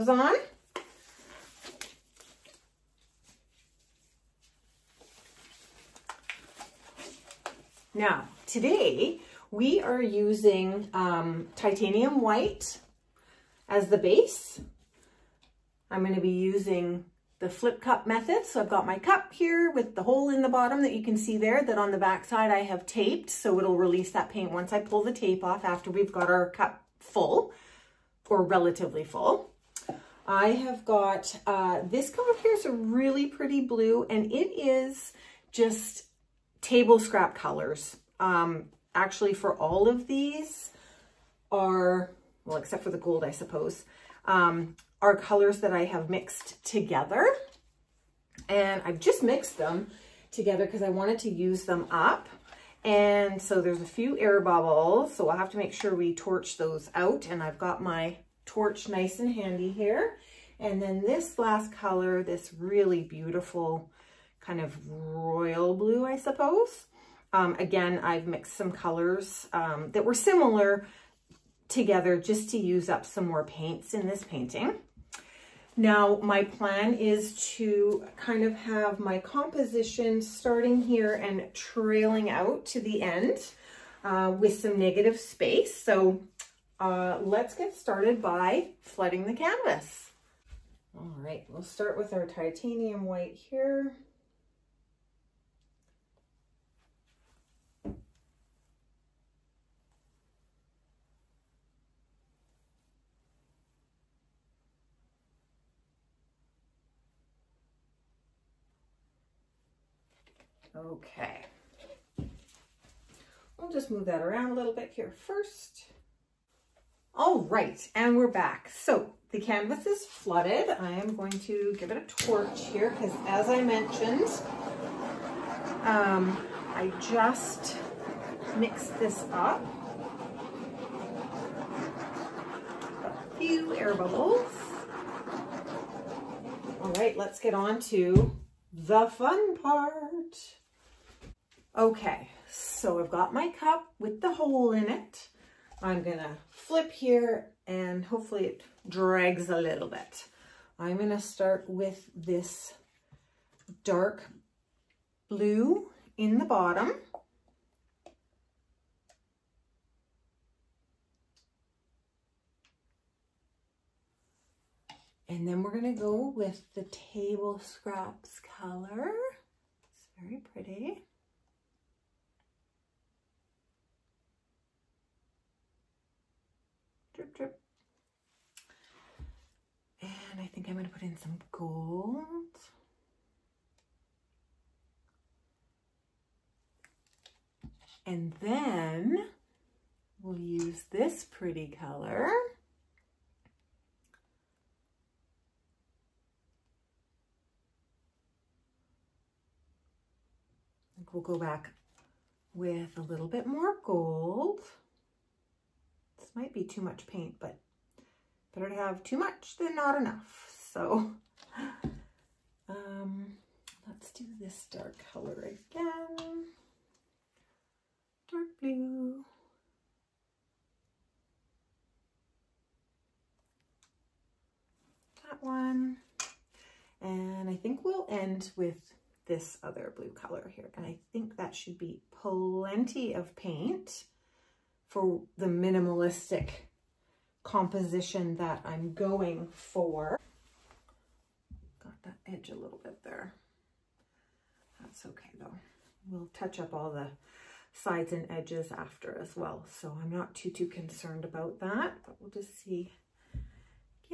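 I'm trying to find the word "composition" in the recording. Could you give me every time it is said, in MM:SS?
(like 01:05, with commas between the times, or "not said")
01:19, 03:57.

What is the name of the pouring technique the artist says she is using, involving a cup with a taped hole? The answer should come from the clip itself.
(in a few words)
flip cup method.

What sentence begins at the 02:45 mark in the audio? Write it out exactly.
And then we're gonna go with the table scraps color.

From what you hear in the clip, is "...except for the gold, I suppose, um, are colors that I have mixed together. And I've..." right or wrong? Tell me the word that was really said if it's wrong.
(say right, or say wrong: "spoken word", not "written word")
right.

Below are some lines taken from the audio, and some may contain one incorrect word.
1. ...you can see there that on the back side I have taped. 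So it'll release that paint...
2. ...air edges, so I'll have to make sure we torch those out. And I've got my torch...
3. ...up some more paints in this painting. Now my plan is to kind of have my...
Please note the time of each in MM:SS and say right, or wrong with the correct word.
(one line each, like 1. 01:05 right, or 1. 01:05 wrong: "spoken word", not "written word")
1. 00:20 right
2. 00:54 wrong: "bubbles", not "edges"
3. 01:12 right.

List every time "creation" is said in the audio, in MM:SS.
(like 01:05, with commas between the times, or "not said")
not said.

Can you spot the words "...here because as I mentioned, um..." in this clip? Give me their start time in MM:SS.
02:02.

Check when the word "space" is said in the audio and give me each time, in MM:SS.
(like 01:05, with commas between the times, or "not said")
01:25.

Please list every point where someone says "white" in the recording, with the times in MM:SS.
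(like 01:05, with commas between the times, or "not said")
00:12, 01:33.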